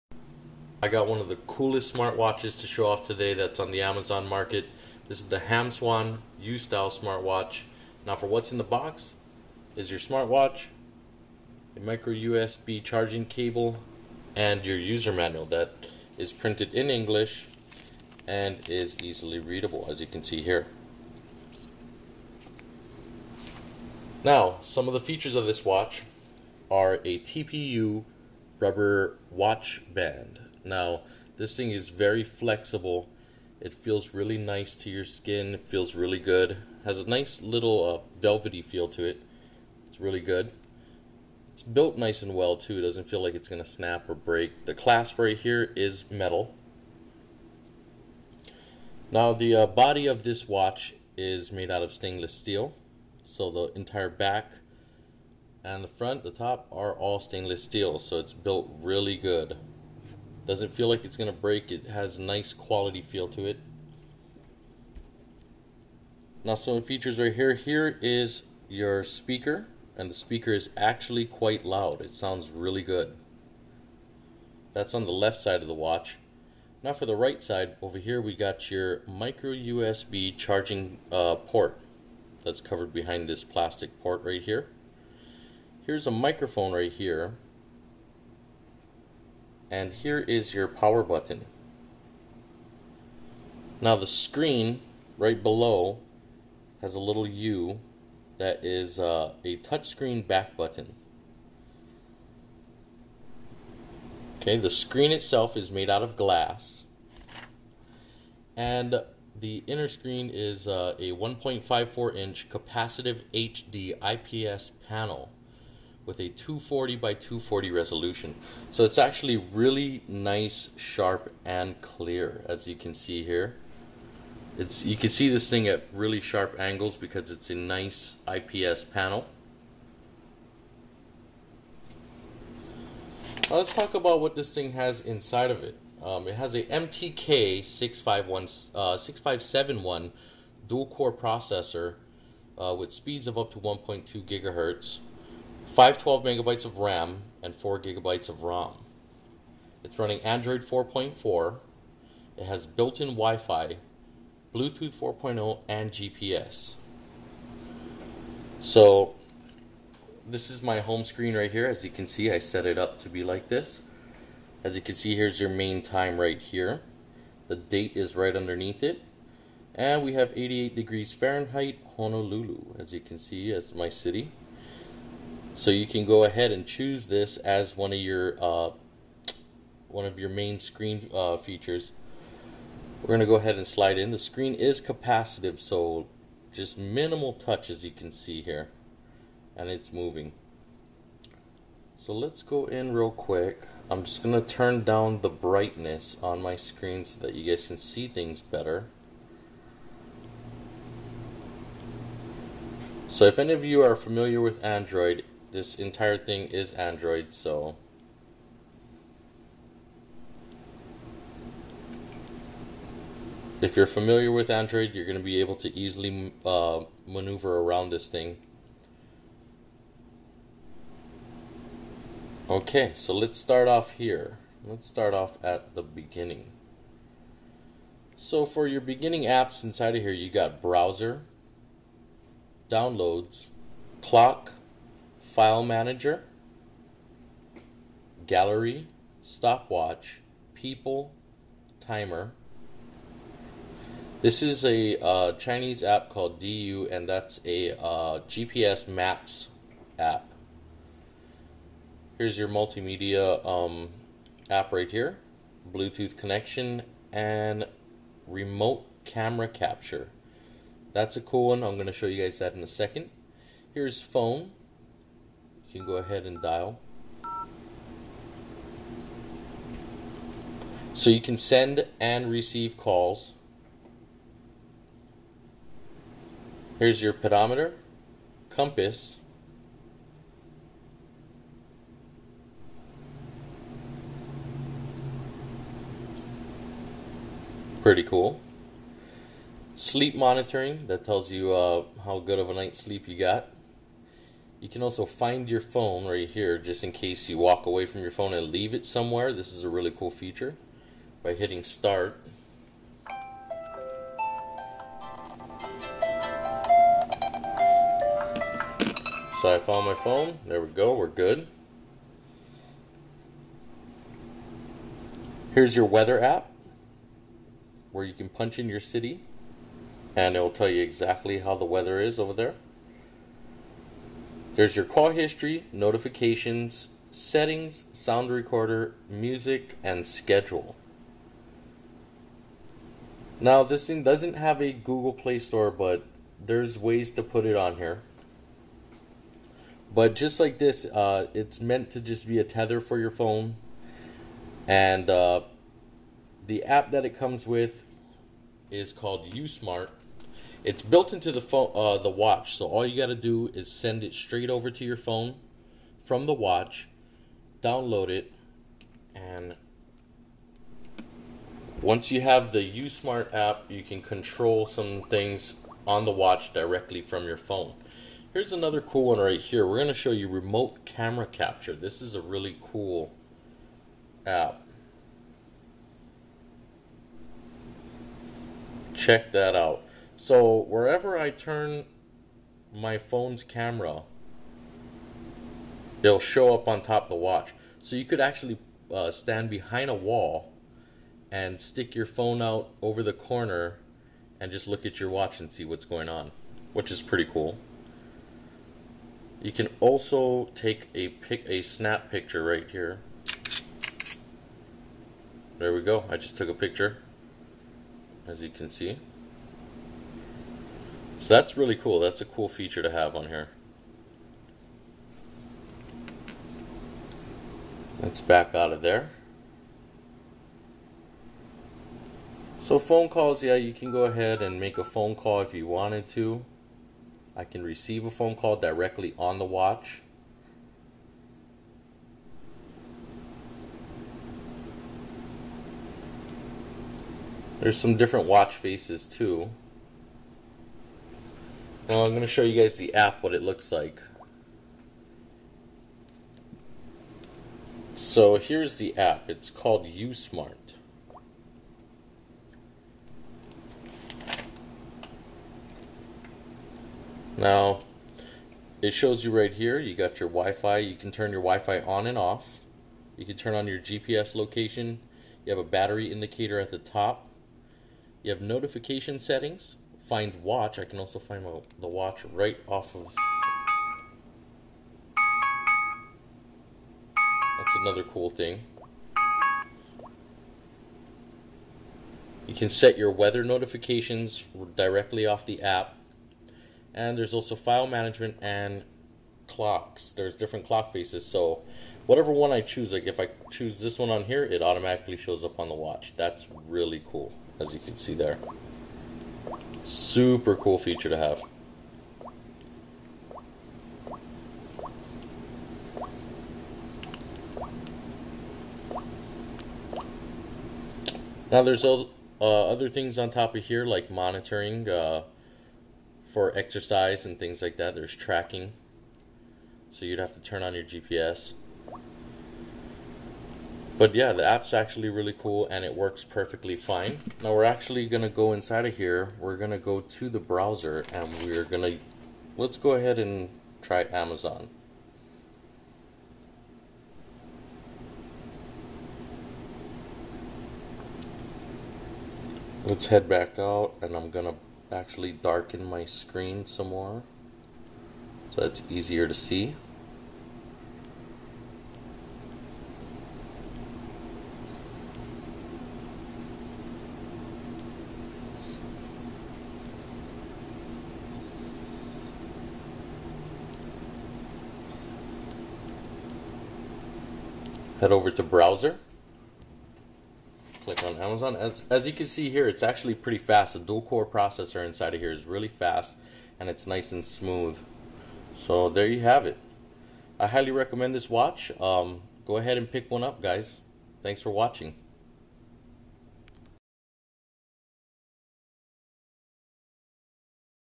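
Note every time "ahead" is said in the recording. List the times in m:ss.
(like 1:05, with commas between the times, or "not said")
2:56, 3:03, 4:25, 7:04, 8:52, 9:42.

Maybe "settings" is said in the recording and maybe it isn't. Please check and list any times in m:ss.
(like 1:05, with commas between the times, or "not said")
5:27, 7:49.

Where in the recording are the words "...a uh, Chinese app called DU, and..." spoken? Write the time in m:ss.
4:04.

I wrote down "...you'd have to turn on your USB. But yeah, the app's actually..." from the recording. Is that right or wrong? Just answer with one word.
wrong.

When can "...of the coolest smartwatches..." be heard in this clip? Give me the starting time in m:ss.
0:01.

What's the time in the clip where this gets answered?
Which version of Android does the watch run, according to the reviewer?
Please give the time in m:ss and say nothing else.
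2:30.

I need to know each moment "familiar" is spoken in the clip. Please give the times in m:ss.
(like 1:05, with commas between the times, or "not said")
3:23, 3:33.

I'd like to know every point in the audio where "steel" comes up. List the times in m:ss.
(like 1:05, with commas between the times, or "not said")
0:52, 0:57.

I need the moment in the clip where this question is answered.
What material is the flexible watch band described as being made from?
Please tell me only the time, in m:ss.
0:27.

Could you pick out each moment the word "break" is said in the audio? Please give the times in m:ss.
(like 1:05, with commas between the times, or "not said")
0:44, 1:01.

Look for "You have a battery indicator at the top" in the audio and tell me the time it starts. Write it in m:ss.
7:45.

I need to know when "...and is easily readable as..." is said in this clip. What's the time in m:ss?
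0:18.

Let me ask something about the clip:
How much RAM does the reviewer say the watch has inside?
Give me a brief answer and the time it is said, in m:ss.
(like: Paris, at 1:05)
512 megabytes, at 2:25.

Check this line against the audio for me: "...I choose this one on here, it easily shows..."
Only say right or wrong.
wrong.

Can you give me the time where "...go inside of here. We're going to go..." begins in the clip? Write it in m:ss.
8:48.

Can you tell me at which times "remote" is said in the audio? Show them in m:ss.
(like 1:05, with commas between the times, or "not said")
4:18, 6:10.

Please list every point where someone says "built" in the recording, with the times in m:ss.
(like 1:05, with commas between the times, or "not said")
0:41, 0:58, 2:32, 5:50.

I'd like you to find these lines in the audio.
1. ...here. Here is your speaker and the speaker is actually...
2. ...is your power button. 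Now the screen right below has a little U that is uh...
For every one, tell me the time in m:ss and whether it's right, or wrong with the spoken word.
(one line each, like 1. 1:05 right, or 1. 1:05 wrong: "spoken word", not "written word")
1. 1:07 right
2. 1:30 right.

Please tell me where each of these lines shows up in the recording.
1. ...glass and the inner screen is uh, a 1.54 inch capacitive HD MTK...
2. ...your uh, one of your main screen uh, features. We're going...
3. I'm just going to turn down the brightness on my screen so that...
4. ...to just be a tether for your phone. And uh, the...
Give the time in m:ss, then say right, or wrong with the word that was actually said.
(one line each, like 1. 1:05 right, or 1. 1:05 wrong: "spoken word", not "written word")
1. 1:46 wrong: "IPS", not "MTK"
2. 2:57 right
3. 3:13 right
4. 5:41 right.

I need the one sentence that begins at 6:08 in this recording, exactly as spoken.
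Here's another cool one right here.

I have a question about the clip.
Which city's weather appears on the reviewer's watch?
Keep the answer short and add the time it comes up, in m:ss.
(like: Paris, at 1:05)
Honolulu, at 2:51.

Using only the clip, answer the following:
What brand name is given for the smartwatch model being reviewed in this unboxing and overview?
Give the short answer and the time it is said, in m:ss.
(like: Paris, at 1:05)
Hamswan, at 0:05.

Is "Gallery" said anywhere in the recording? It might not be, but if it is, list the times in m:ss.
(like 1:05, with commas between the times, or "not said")
3:58.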